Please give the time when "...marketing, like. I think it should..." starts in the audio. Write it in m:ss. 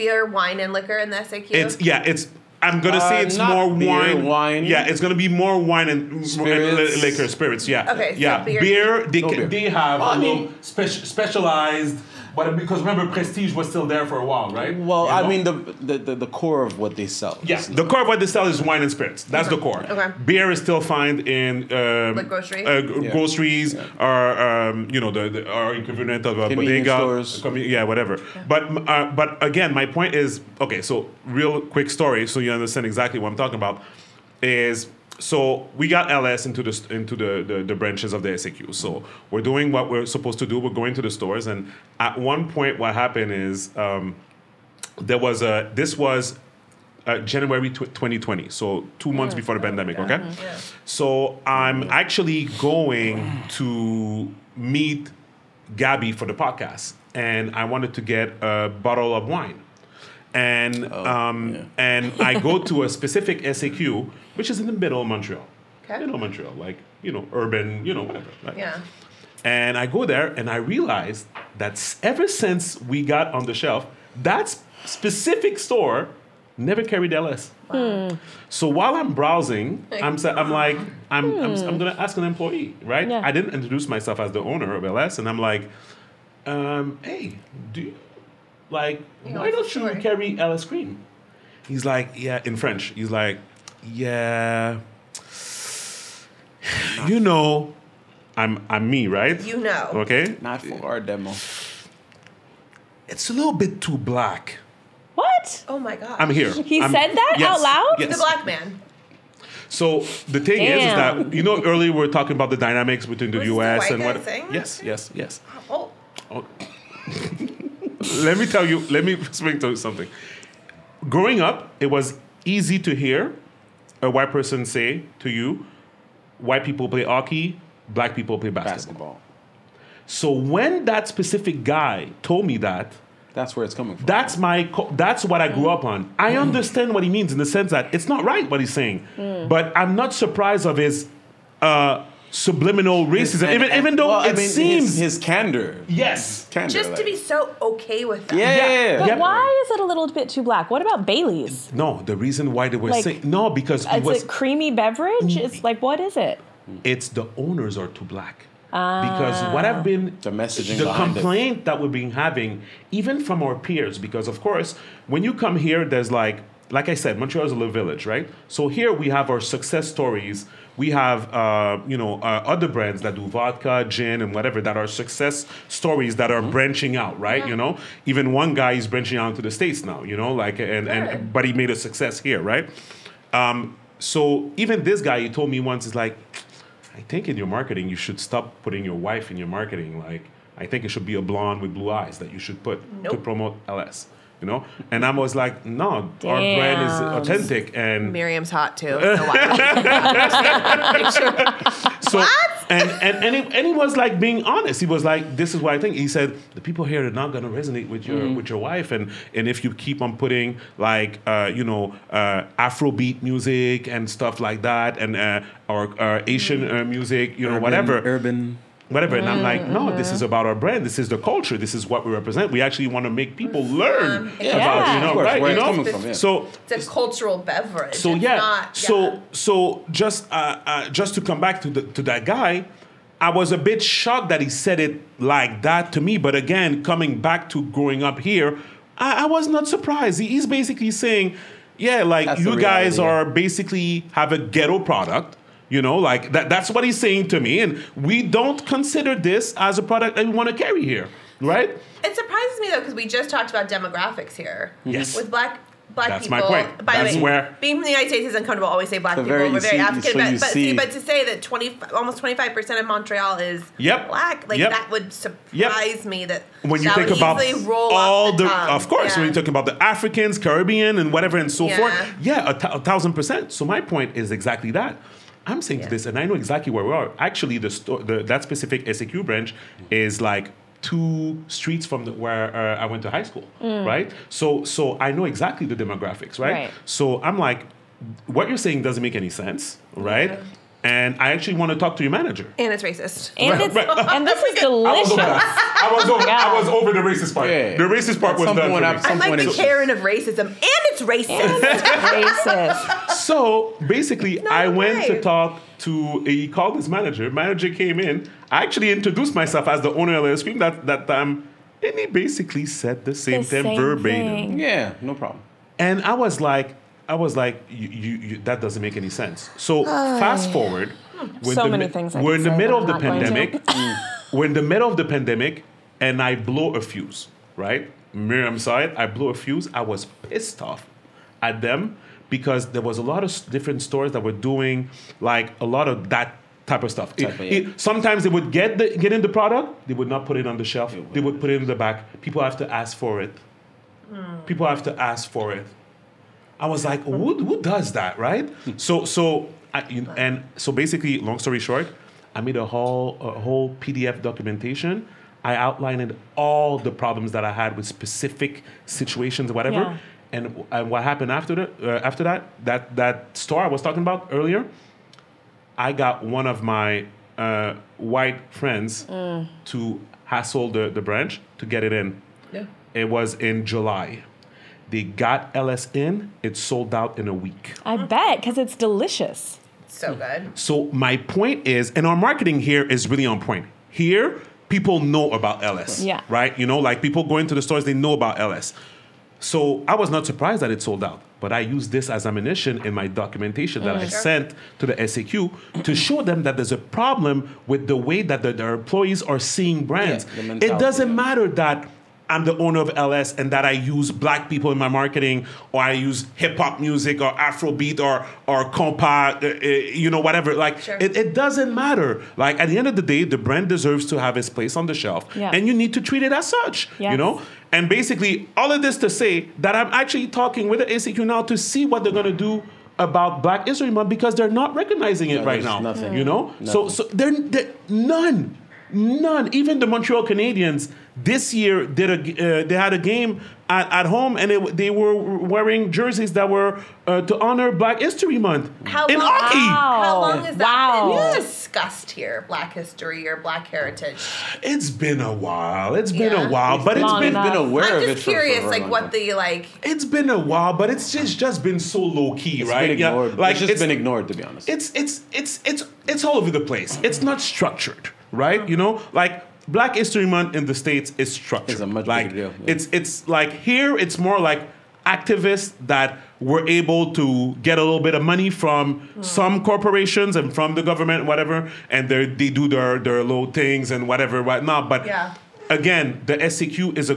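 3:09.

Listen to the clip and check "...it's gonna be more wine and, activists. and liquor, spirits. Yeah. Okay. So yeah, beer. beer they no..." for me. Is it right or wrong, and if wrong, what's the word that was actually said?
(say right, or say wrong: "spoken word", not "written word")
wrong: "spirits", not "activists".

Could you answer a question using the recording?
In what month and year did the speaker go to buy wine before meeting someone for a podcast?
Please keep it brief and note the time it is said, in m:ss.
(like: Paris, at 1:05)
January 2020, at 0:47.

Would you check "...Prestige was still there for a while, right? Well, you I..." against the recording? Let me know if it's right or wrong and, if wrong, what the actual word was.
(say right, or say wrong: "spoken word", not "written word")
right.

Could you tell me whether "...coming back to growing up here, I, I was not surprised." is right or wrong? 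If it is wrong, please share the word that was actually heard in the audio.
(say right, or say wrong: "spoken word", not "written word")
right.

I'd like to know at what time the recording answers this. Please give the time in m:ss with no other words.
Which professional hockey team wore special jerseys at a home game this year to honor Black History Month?
7:09.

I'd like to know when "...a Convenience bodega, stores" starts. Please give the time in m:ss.
0:26.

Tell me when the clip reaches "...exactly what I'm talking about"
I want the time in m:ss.
0:32.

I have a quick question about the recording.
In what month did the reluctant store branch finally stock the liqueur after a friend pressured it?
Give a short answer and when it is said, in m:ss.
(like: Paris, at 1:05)
July, at 6:13.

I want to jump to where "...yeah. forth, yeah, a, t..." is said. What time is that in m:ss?
4:31.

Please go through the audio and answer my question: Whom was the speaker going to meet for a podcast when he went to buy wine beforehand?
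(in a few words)
Gaby.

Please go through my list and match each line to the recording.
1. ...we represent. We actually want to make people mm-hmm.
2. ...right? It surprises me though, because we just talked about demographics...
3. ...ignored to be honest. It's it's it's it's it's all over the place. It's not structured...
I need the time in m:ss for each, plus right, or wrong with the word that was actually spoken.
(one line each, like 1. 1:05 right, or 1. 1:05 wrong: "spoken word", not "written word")
1. 3:42 right
2. 4:11 right
3. 7:33 right.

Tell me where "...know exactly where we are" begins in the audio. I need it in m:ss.
4:36.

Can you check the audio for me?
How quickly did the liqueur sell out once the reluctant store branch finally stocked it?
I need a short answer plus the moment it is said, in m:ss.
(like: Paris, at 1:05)
in a week, at 6:17.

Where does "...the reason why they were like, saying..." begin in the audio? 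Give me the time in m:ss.
2:32.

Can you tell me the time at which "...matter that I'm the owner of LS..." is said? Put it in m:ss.
6:41.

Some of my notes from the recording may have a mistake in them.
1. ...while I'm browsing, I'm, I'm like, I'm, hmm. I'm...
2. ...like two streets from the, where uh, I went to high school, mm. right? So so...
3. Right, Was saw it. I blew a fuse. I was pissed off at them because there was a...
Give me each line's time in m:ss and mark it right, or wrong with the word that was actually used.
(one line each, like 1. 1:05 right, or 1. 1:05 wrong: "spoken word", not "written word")
1. 1:18 right
2. 4:40 right
3. 5:27 wrong: "Miriam", not "Was".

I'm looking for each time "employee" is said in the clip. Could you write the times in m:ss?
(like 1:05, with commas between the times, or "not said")
1:22, 6:38.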